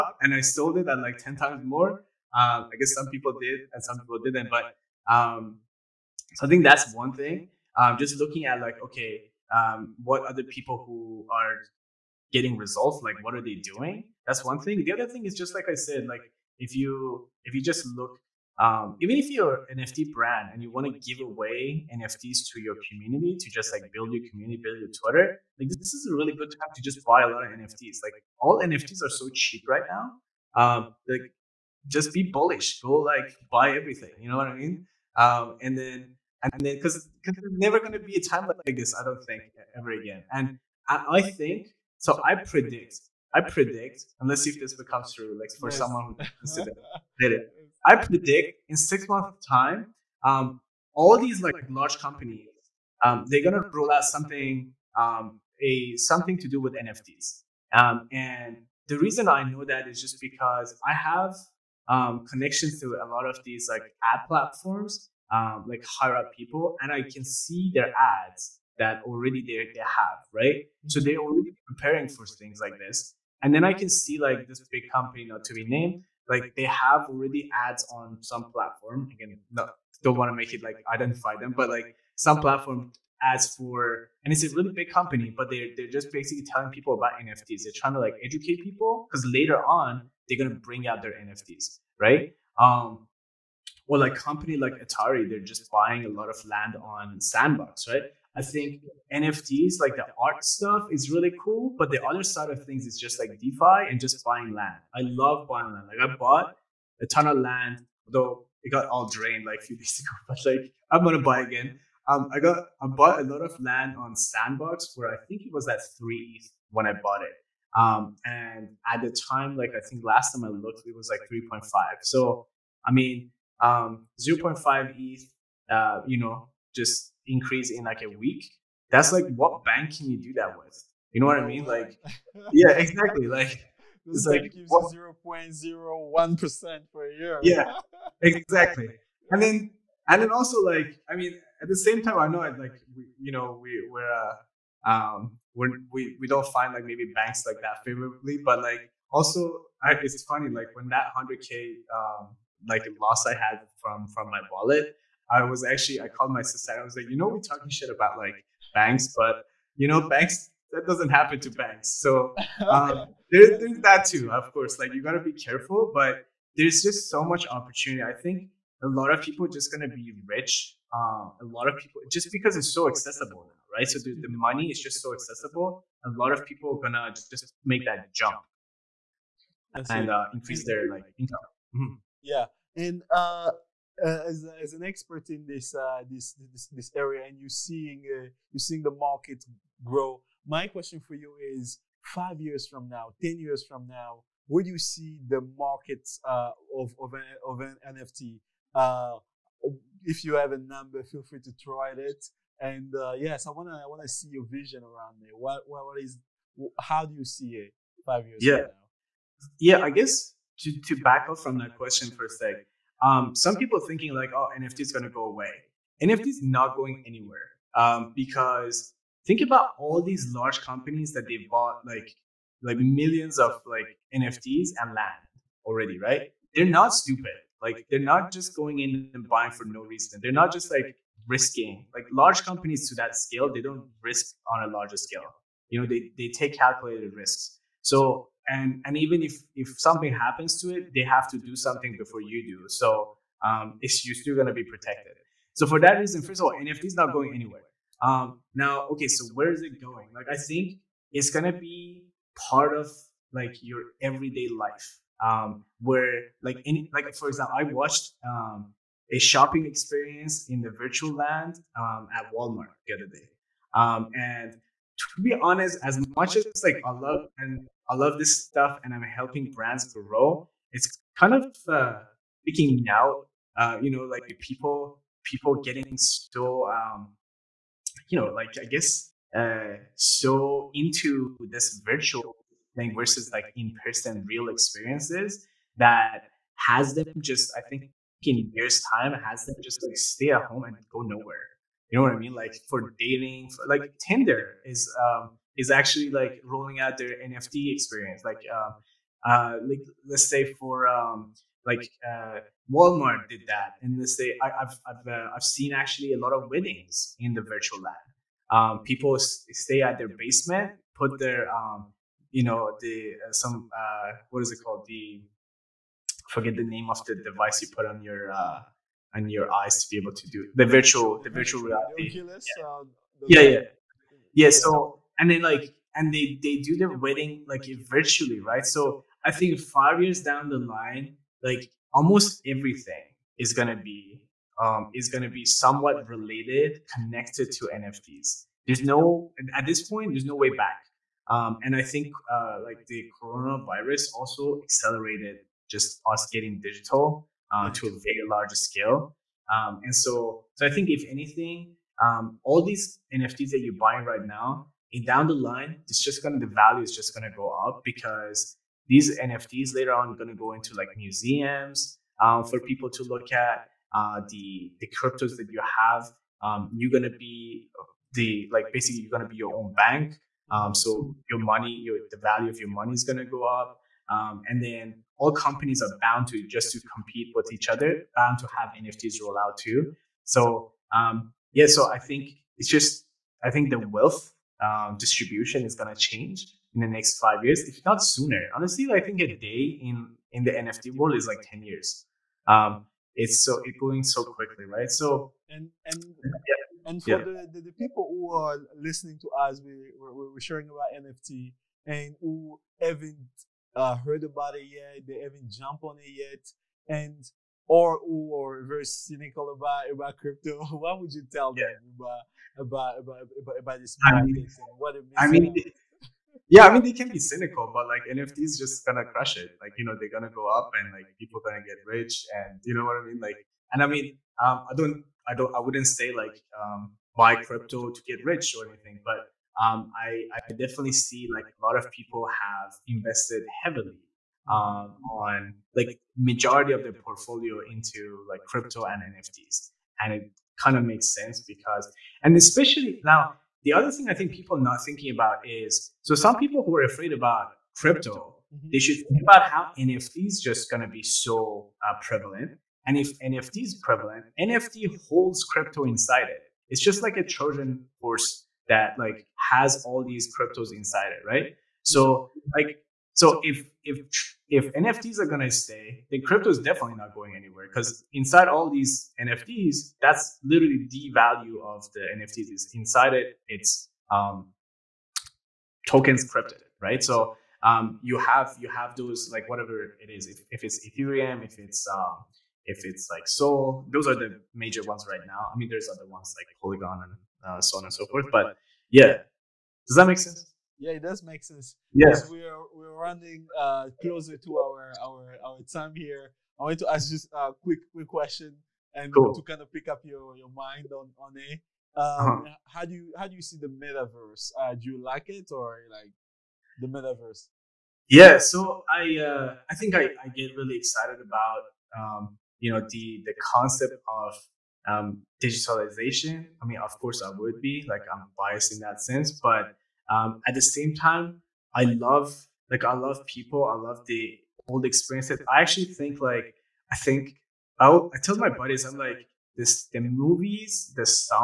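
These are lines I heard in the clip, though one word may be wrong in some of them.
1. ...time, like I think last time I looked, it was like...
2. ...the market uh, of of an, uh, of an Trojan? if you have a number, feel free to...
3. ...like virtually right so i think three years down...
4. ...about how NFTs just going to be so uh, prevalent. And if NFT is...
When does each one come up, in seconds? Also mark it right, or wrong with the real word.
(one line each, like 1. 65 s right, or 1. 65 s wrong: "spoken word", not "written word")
1. 119 s right
2. 195 s wrong: "NFT", not "Trojan"
3. 327 s wrong: "five", not "three"
4. 449 s right.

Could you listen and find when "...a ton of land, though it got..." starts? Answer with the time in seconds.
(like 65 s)
107 s.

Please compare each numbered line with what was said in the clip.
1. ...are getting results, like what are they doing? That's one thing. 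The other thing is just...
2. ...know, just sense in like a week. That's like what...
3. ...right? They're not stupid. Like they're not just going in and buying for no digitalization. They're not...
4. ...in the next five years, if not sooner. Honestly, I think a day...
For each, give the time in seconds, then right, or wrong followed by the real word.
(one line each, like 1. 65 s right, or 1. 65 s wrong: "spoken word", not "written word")
1. 11 s right
2. 126 s wrong: "increase", not "sense"
3. 225 s wrong: "reason", not "digitalization"
4. 386 s right.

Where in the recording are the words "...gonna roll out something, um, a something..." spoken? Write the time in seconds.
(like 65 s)
53 s.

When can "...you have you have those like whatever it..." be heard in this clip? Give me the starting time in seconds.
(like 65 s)
478 s.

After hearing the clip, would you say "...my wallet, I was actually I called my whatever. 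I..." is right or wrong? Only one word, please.
wrong.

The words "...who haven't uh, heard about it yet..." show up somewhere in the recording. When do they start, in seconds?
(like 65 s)
402 s.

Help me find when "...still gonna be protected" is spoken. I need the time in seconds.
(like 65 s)
244 s.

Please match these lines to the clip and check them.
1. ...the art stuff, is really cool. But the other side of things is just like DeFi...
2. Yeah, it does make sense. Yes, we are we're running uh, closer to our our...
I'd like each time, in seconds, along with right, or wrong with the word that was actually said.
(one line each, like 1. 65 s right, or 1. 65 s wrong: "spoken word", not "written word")
1. 99 s right
2. 490 s right.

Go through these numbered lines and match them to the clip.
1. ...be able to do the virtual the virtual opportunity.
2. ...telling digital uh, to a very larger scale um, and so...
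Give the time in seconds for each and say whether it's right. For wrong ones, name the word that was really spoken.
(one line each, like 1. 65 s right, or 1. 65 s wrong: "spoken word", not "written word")
1. 319 s wrong: "reality", not "opportunity"
2. 346 s wrong: "getting", not "telling".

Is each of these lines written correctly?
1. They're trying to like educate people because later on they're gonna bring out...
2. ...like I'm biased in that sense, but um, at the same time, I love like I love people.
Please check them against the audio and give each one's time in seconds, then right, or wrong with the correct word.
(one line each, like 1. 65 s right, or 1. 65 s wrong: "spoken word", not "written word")
1. 87 s right
2. 517 s right.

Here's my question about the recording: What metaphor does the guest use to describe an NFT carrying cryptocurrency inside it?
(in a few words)
Trojan horse.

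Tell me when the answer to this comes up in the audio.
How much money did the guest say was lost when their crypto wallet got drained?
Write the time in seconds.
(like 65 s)
151 s.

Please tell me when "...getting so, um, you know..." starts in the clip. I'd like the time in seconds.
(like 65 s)
275 s.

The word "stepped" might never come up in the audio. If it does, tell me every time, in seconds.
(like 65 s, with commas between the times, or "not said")
not said.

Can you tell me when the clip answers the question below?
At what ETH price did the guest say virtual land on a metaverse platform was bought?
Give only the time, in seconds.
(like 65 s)
115 s.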